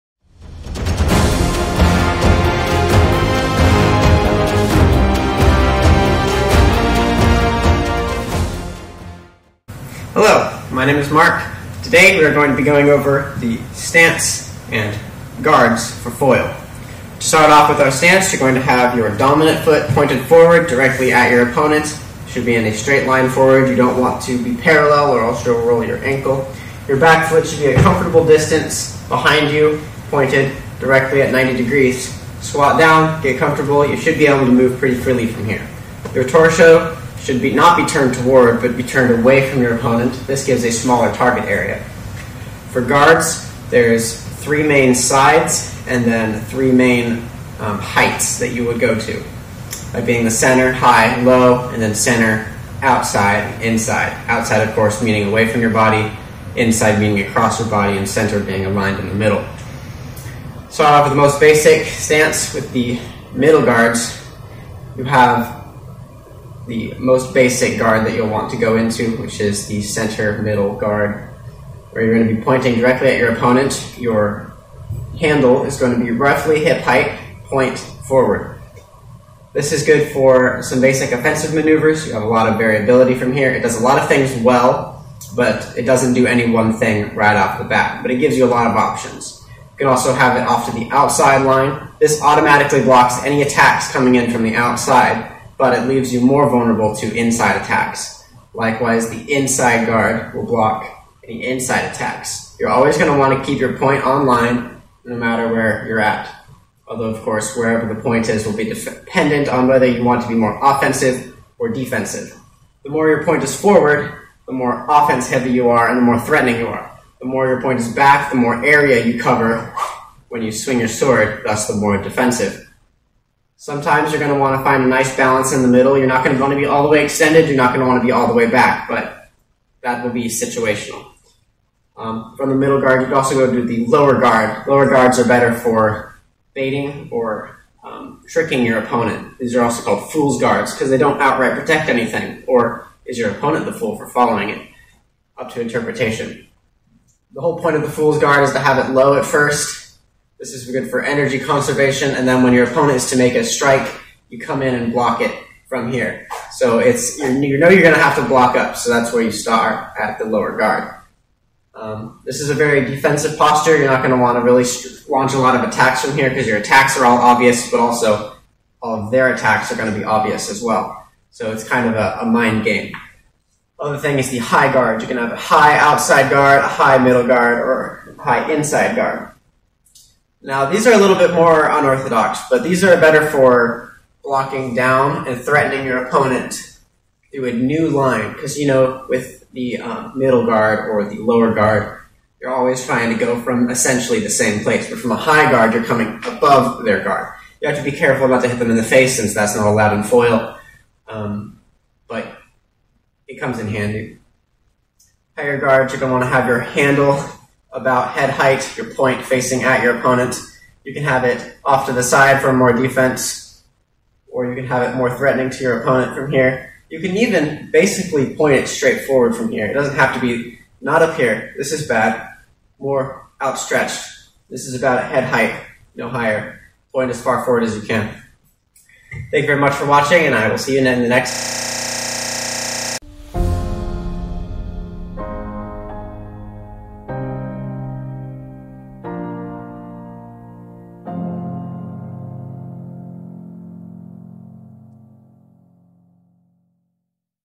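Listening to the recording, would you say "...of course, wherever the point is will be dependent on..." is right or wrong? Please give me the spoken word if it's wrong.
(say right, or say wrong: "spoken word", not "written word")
right.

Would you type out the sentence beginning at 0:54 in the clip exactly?
Outside, of course, meaning away from your body, inside meaning across your body, and center being aligned in the middle.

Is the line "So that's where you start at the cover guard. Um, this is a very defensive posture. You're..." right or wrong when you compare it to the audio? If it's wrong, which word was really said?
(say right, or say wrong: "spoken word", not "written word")
wrong: "lower", not "cover".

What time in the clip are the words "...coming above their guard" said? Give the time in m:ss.
3:15.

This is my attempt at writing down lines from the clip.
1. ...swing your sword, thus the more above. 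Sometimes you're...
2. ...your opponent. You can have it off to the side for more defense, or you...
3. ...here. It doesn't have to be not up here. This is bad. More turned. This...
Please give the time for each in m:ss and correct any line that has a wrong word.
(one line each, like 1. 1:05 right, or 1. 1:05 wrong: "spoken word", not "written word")
1. 2:00 wrong: "defensive", not "above"
2. 3:29 right
3. 3:39 wrong: "outstretched", not "turned".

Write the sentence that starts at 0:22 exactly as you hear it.
Should be in a straight line forward.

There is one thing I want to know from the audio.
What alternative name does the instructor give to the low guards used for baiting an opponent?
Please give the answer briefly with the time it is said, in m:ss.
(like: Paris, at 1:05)
Fool's guards, at 2:20.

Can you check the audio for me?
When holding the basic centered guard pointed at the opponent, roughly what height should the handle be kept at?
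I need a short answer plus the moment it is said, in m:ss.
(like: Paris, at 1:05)
Hip height, at 1:16.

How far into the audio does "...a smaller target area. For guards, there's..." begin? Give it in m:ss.
0:40.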